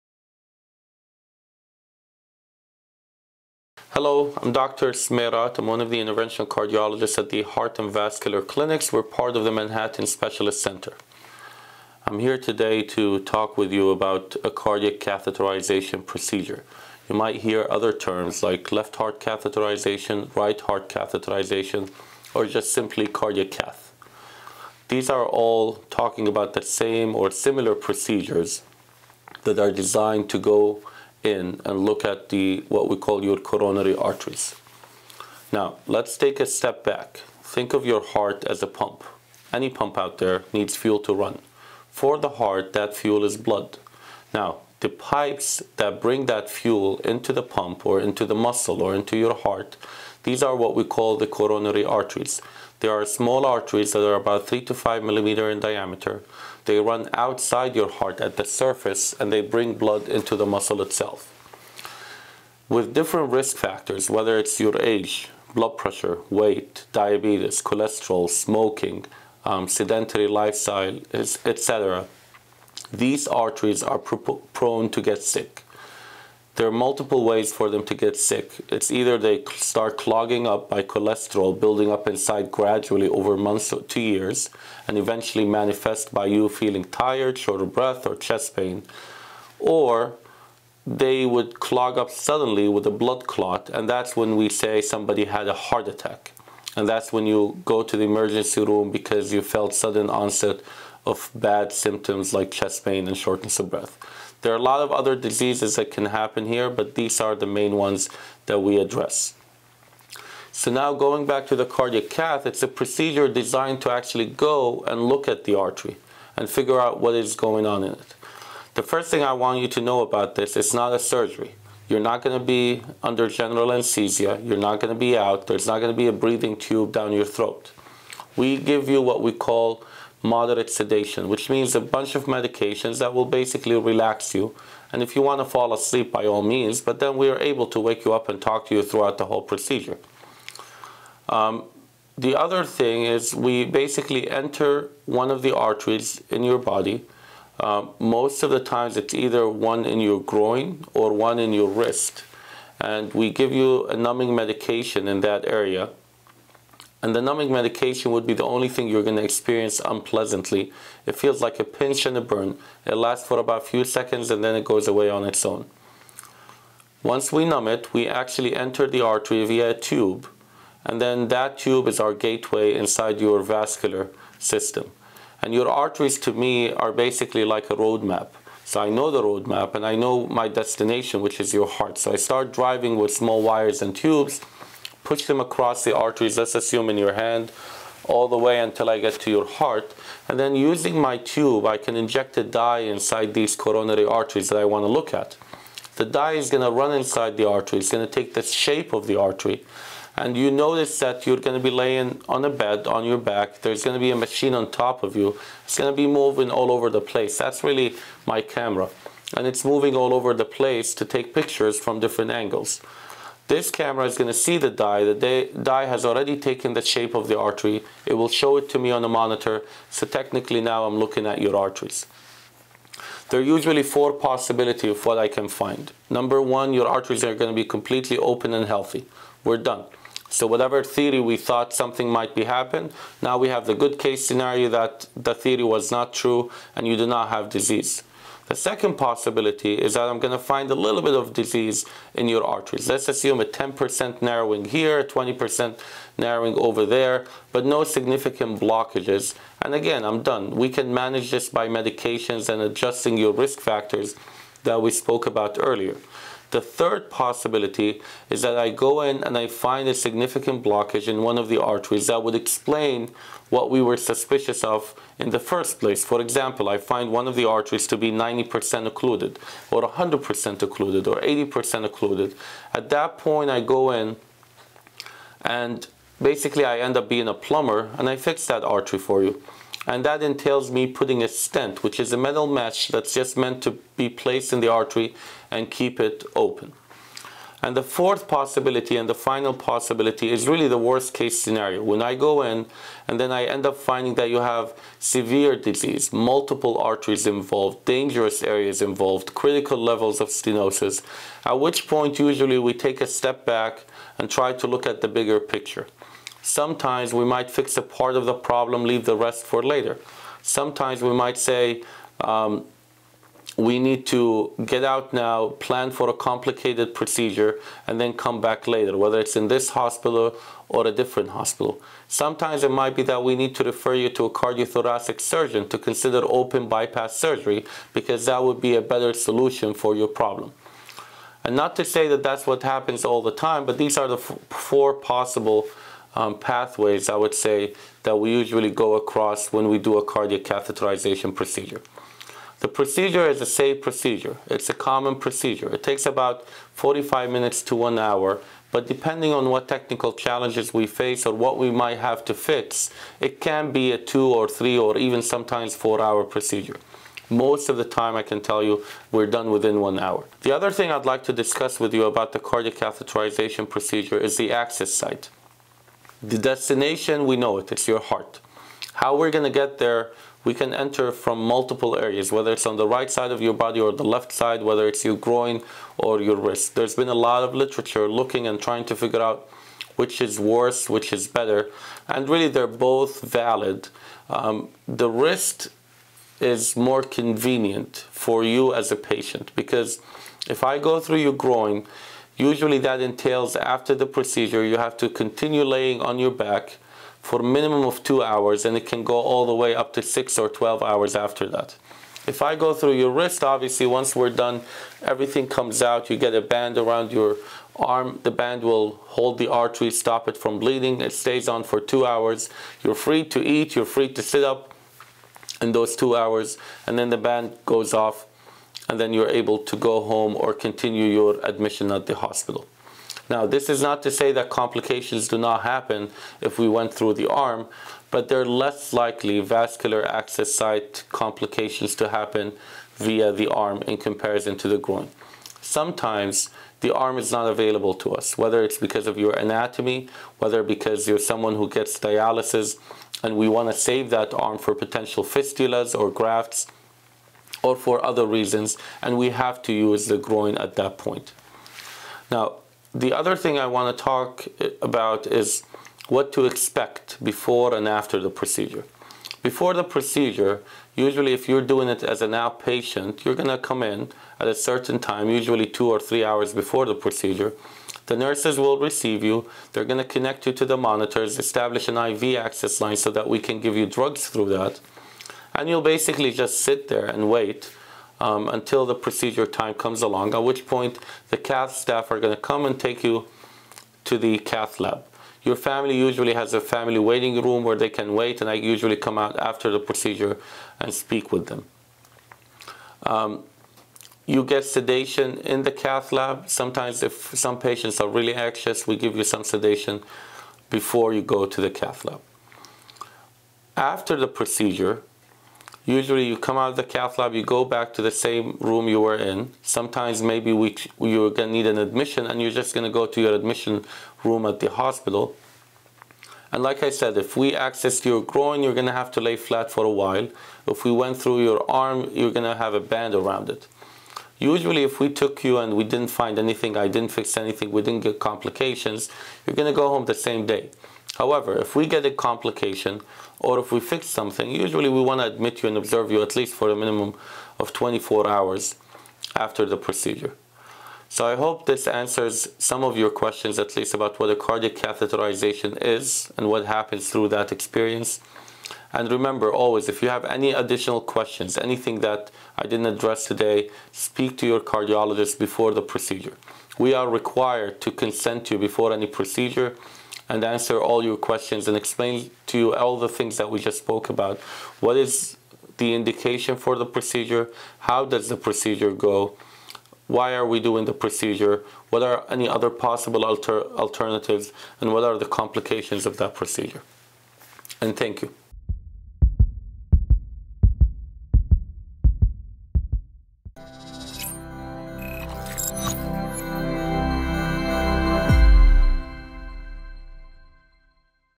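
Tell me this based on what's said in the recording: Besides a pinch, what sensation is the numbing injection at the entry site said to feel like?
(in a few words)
a burn.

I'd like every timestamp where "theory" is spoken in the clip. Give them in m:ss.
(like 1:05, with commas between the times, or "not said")
3:50, 3:55.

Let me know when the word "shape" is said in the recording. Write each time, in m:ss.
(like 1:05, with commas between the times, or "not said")
3:18, 3:36.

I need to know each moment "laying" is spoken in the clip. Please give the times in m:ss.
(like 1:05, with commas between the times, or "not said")
3:21, 6:35.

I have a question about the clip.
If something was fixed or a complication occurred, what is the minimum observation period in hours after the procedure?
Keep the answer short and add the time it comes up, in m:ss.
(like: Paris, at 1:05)
24, at 8:57.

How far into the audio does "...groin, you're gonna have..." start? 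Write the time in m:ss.
8:38.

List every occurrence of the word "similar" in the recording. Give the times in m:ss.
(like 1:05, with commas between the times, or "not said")
0:27.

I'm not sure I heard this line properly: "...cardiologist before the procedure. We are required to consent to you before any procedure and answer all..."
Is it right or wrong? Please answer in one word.
right.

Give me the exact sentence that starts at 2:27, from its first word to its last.
Um, most of the times it's either one in your groin or one in your wrist.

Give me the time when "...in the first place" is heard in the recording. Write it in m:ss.
4:25.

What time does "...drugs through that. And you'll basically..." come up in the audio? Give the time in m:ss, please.
7:53.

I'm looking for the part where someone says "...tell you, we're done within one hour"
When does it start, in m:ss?
5:58.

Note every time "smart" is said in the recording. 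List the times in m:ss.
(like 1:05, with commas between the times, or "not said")
not said.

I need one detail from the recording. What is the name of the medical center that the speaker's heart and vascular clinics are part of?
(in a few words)
Manhattan Specialist Center.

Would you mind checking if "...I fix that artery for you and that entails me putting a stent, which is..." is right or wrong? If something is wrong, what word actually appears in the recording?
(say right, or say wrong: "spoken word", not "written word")
right.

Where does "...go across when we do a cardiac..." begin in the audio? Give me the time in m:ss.
5:38.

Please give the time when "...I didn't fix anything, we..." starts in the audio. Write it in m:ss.
8:46.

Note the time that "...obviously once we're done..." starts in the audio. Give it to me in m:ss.
6:43.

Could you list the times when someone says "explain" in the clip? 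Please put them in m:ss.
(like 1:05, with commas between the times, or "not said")
4:22, 9:21.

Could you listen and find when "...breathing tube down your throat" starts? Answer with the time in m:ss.
2:06.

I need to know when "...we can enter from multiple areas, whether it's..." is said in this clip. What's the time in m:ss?
6:10.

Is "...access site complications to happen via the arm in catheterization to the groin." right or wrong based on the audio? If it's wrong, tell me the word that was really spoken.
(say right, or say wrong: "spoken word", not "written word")
wrong: "comparison", not "catheterization".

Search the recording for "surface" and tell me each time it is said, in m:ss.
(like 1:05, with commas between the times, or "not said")
0:58.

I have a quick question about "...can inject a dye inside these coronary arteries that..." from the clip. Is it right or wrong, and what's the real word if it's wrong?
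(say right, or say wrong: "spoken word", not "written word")
right.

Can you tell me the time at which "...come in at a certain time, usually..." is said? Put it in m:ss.
7:43.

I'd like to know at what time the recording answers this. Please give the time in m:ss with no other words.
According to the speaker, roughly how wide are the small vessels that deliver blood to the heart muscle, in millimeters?
0:54.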